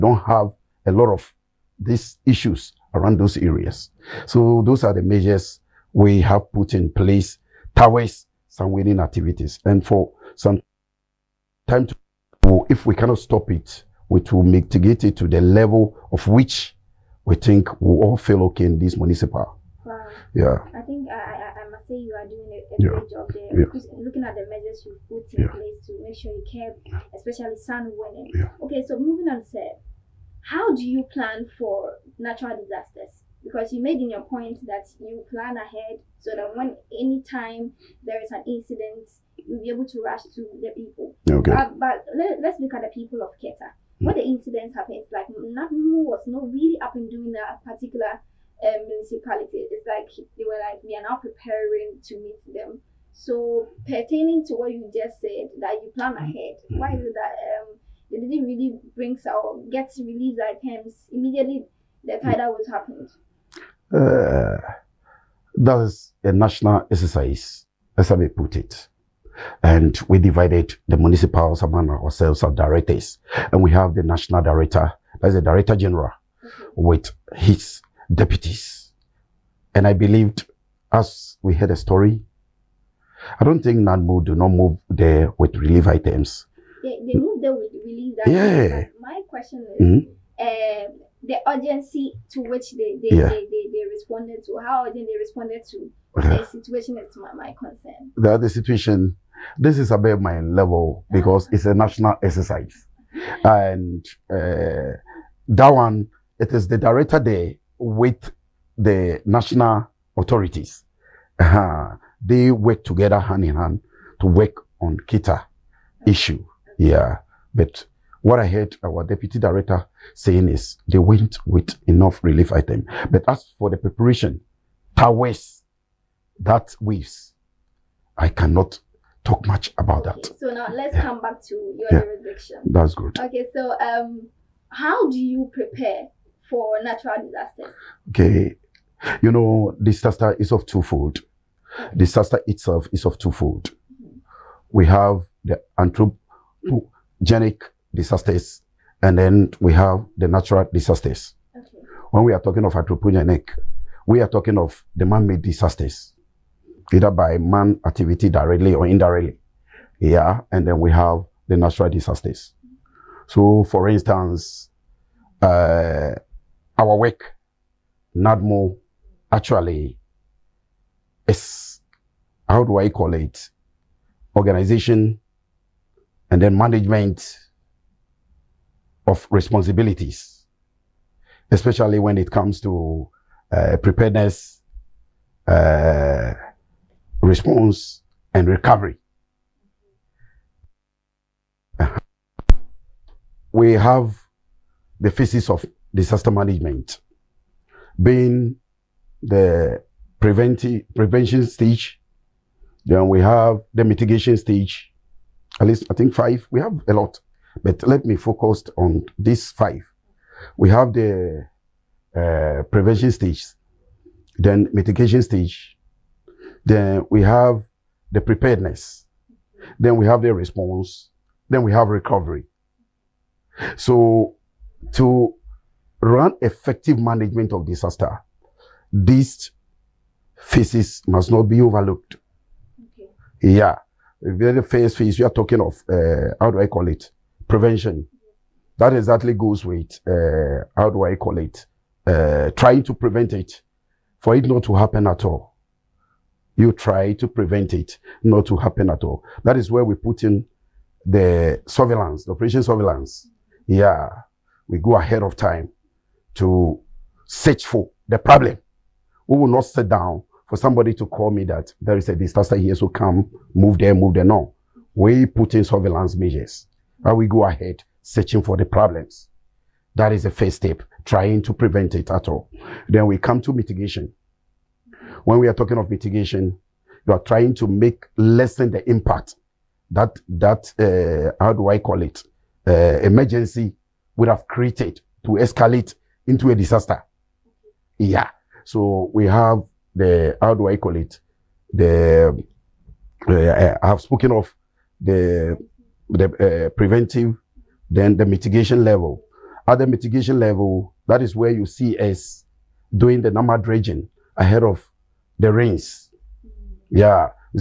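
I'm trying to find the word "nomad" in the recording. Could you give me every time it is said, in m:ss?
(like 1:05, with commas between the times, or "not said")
5:03.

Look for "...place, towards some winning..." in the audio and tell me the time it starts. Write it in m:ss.
0:06.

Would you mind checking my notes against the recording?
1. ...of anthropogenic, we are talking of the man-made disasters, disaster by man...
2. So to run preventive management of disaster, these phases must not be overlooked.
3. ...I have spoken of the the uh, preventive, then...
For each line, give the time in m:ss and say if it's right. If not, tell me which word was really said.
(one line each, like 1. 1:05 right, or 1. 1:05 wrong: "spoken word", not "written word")
1. 2:32 wrong: "either", not "disaster"
2. 3:43 wrong: "effective", not "preventive"
3. 4:53 right.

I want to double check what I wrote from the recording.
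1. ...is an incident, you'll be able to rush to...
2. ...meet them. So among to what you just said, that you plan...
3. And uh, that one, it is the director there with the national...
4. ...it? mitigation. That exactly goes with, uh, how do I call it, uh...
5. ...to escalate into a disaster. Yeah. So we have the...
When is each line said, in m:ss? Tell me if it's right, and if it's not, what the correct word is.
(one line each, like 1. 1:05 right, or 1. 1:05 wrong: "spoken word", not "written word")
1. 0:38 right
2. 0:52 wrong: "pertaining", not "among"
3. 1:43 right
4. 3:56 wrong: "prevention", not "mitigation"
5. 4:45 right.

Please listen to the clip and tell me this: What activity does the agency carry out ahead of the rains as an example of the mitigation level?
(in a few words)
dredging.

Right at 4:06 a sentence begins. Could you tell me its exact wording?
You try to prevent it not to happen at all.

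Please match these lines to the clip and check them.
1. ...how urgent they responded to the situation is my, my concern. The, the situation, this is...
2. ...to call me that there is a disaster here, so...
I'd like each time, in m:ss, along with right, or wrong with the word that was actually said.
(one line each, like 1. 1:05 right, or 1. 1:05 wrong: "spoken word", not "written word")
1. 1:34 right
2. 4:21 right.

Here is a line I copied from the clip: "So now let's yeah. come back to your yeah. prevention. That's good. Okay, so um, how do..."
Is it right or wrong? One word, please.
wrong.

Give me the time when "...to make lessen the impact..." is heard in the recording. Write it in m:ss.
4:37.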